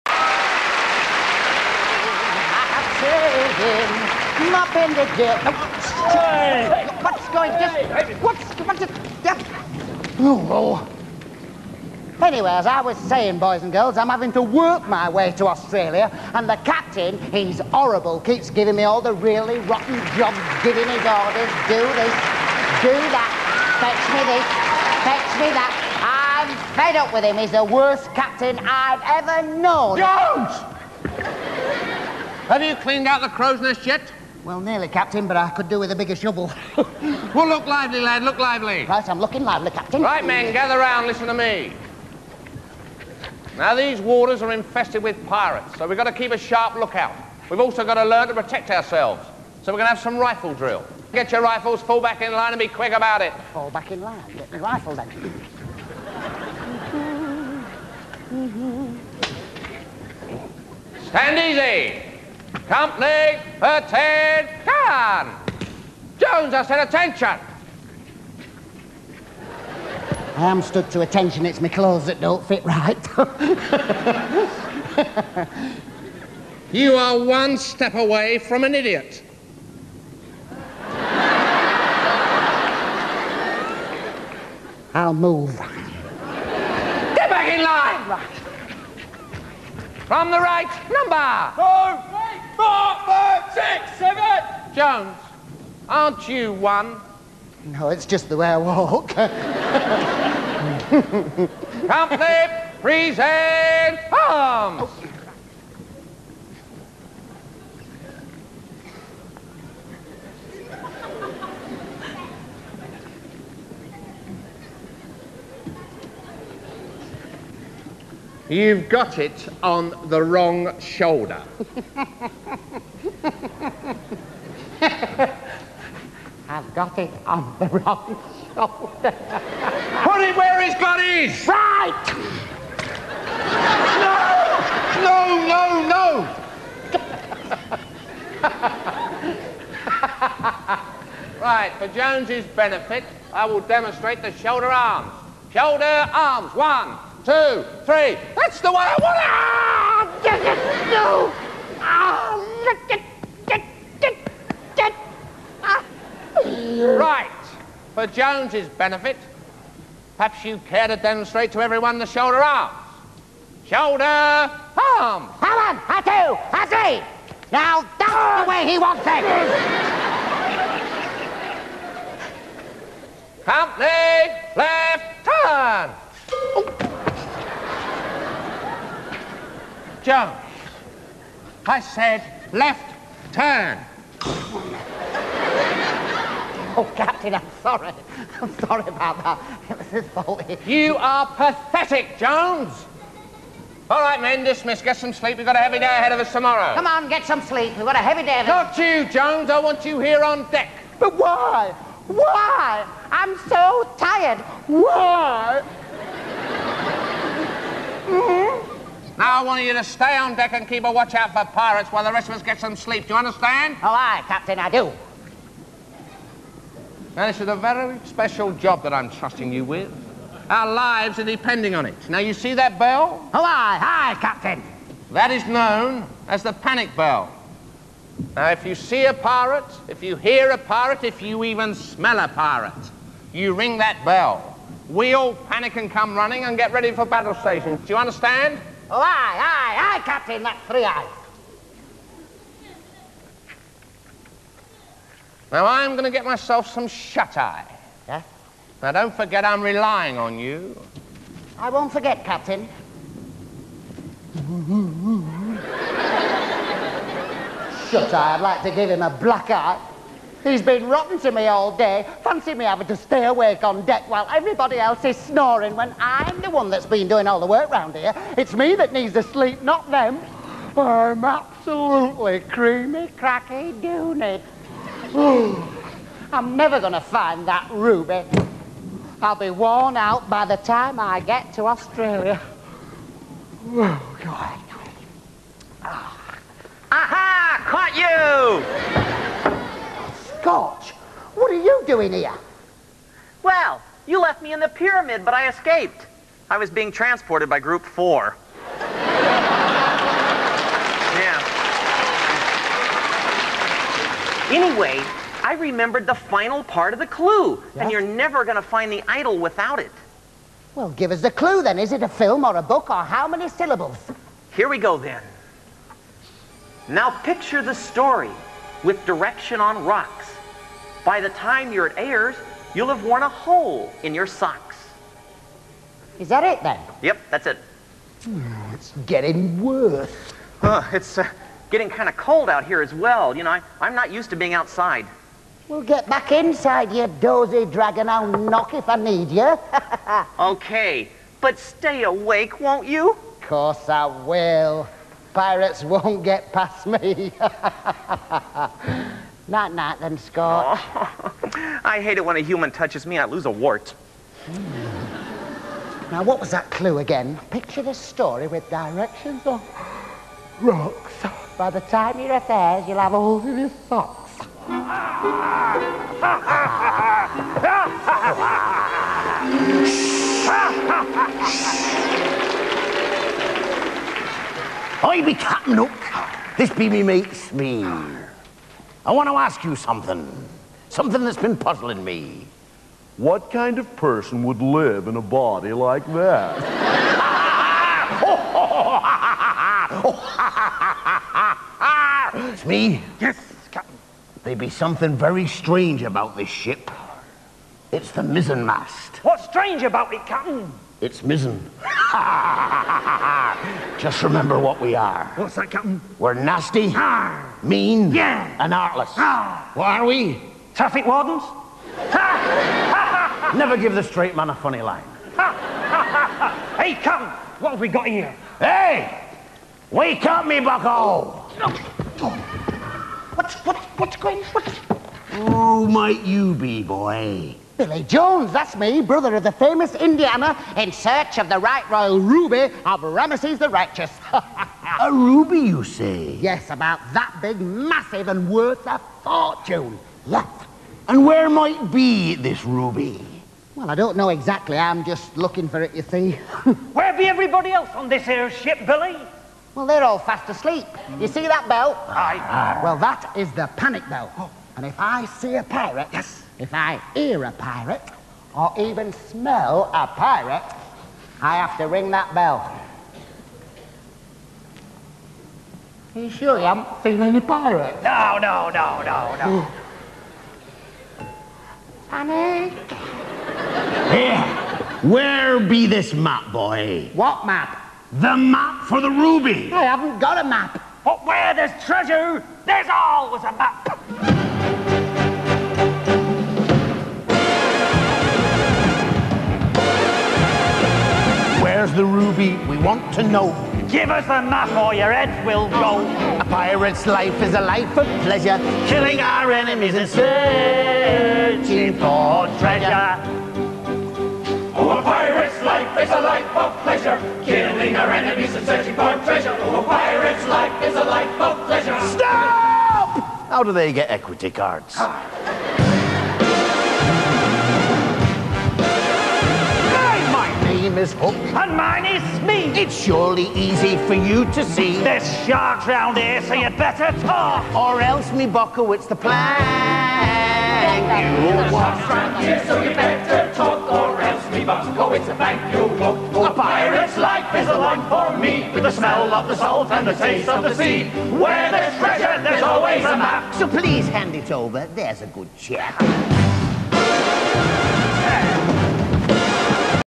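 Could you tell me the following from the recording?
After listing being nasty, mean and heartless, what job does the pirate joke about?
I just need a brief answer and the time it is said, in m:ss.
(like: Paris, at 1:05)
Traffic wardens, at 6:50.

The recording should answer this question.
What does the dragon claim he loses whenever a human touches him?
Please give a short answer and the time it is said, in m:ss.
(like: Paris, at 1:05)
A wart, at 5:53.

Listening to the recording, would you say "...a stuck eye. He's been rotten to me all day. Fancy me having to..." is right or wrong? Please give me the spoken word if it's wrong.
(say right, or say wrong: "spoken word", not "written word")
wrong: "black", not "stuck".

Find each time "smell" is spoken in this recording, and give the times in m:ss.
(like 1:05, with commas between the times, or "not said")
3:51, 7:39, 8:58.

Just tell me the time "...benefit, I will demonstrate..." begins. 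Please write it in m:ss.
2:22.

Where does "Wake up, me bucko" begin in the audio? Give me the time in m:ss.
6:59.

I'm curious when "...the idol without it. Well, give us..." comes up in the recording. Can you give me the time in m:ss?
5:08.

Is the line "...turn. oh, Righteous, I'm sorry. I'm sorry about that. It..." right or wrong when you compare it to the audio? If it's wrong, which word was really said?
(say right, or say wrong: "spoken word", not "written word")
wrong: "Captain", not "Righteous".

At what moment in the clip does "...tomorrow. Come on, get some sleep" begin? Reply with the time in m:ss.
3:16.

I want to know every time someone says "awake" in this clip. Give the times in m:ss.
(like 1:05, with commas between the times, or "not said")
4:23, 5:42.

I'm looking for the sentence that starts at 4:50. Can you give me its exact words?
Scorch, What are you doing here?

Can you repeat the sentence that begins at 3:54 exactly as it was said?
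We all panic and come running and get ready for battle stations.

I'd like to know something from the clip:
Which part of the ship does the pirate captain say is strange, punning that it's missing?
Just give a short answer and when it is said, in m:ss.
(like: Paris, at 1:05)
The mizzenmast, at 6:38.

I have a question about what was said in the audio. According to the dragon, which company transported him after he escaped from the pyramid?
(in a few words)
Group 4.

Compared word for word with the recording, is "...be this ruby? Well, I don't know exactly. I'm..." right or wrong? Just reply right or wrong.
right.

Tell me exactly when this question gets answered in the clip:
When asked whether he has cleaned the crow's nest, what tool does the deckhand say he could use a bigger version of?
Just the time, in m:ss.
0:35.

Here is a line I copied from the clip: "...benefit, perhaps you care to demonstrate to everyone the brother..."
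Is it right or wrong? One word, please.
wrong.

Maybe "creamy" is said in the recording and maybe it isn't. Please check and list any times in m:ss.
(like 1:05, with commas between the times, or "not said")
4:32.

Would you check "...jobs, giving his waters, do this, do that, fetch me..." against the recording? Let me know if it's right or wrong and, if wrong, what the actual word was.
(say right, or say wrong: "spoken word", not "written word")
wrong: "orders", not "waters".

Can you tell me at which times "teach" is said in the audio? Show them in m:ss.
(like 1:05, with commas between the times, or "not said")
not said.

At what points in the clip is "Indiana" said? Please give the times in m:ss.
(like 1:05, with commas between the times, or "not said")
7:09.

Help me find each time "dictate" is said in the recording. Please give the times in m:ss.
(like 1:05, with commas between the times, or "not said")
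not said.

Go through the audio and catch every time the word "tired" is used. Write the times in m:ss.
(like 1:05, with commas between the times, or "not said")
3:23.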